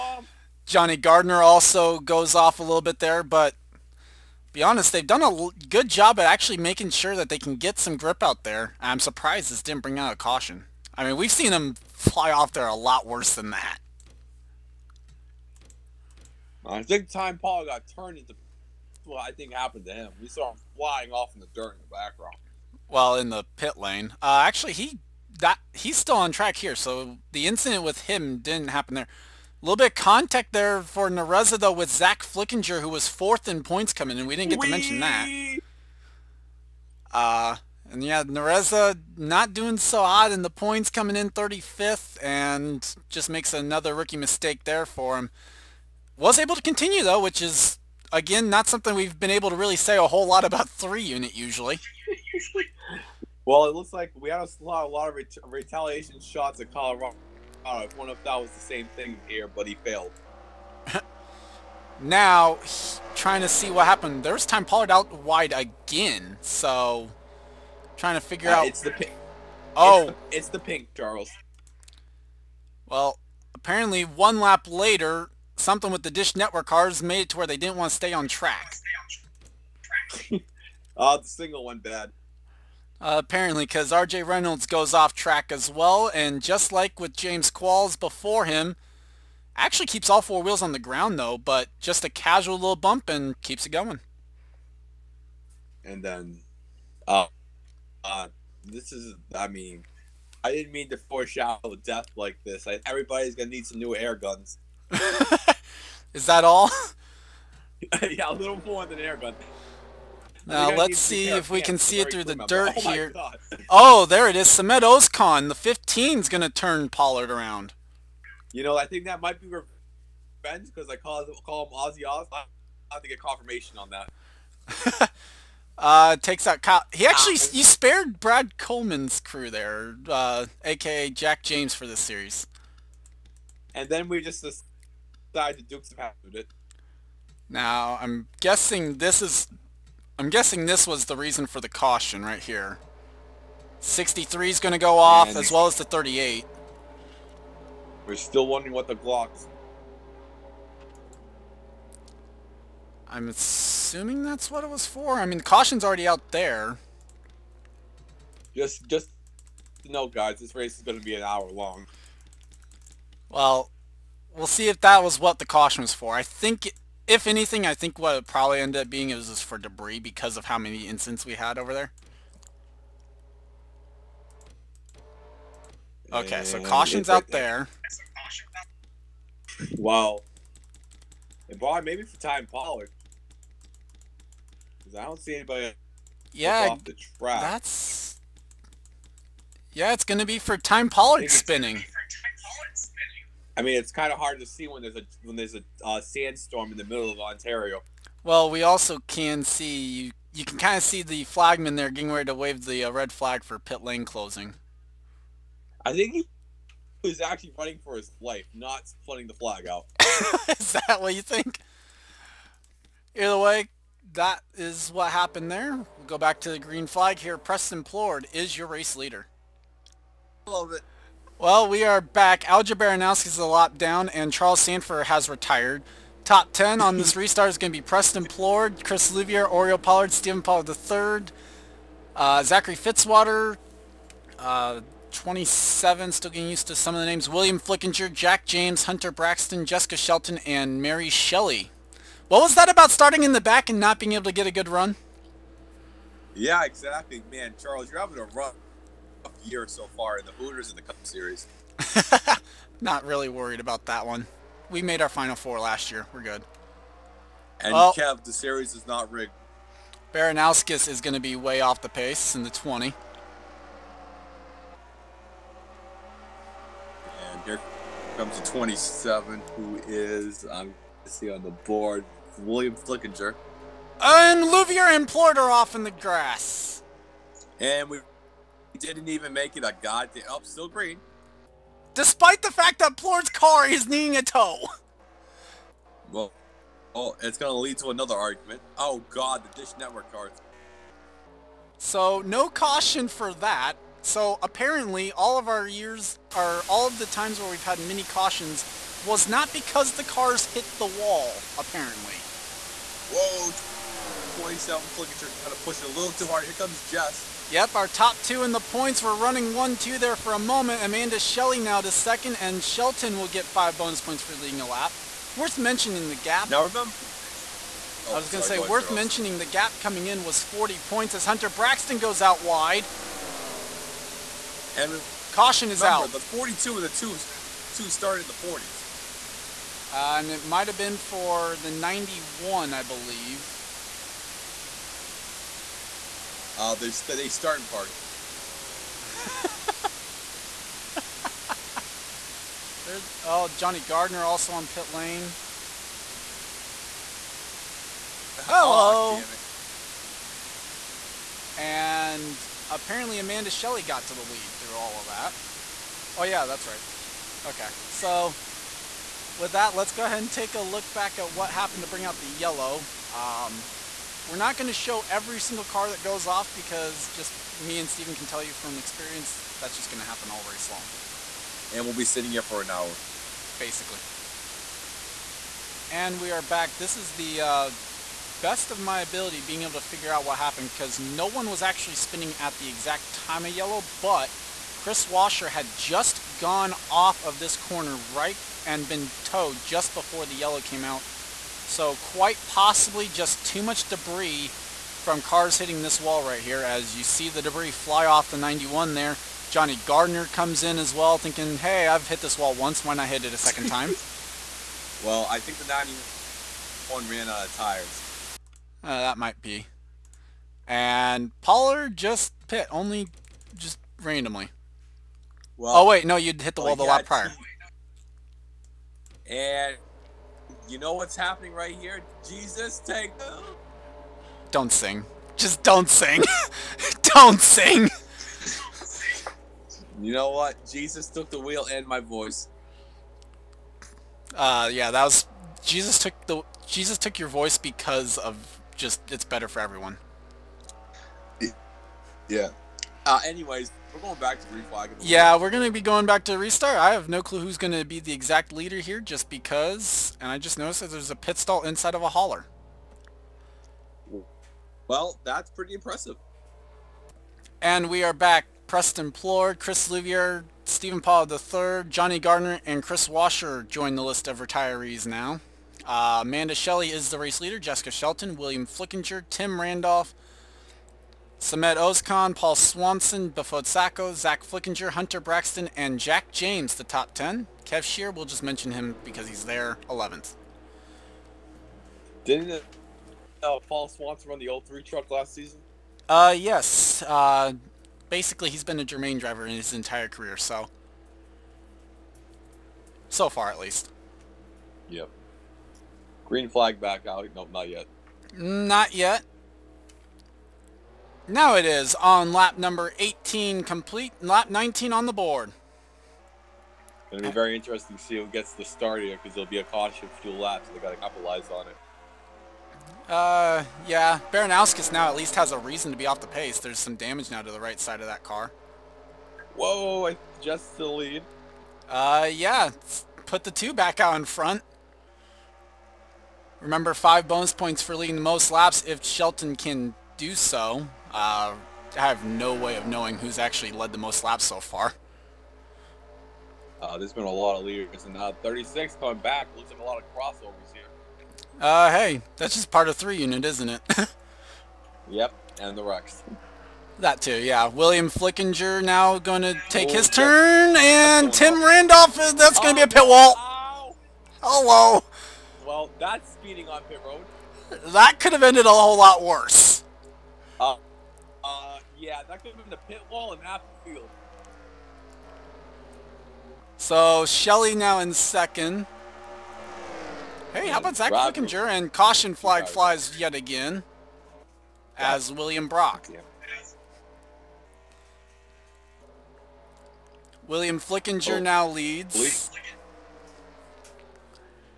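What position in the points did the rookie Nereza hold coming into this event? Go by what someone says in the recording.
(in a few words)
35th.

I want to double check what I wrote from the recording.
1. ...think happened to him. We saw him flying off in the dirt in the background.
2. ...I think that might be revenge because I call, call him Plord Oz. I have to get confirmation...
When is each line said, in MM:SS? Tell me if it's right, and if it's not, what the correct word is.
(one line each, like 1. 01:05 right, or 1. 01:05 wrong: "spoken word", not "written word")
1. 00:19 right
2. 01:58 wrong: "Ozzy", not "Plord".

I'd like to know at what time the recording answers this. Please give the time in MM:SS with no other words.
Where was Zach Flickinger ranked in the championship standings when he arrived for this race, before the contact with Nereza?
00:33.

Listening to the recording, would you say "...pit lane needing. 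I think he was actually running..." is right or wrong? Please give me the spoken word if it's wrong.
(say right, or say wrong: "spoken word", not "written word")
wrong: "closing", not "needing".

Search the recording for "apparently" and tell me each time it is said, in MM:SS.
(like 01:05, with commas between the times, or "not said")
01:13, 01:23, 04:54, 05:01, 05:52.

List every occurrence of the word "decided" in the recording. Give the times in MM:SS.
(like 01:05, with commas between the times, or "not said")
02:14.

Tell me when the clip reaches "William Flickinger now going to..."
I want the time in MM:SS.
09:07.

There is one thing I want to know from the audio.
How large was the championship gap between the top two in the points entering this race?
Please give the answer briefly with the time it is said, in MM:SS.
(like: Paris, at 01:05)
40 points, at 05:20.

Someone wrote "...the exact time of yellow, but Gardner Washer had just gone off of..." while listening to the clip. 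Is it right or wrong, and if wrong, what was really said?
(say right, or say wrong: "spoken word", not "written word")
wrong: "Chris", not "Gardner".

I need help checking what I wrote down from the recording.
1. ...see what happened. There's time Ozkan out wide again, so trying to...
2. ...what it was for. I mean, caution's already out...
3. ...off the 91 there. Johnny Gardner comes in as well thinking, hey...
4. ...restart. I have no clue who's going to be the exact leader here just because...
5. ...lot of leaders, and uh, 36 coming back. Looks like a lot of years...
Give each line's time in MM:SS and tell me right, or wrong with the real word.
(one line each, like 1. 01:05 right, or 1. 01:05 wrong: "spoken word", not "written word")
1. 01:03 wrong: "Pollard", not "Ozkan"
2. 02:34 right
3. 06:38 right
4. 07:26 right
5. 08:57 wrong: "crossovers", not "years".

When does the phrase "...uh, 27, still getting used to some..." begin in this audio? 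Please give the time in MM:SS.
03:54.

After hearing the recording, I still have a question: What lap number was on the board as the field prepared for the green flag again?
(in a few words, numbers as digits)
19.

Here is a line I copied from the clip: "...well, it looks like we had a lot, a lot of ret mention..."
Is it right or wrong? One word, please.
wrong.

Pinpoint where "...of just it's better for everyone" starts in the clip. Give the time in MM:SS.
07:18.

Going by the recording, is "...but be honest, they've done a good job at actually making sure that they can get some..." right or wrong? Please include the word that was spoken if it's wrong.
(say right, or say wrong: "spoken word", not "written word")
right.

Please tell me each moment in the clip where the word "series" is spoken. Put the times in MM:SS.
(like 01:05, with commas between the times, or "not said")
02:11, 04:11, 04:18.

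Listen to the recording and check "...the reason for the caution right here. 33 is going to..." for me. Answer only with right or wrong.
wrong.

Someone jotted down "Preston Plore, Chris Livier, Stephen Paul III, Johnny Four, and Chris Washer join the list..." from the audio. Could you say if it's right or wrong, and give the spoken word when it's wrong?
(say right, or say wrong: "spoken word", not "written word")
wrong: "Gardner", not "Four".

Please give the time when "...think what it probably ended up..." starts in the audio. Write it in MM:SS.
02:47.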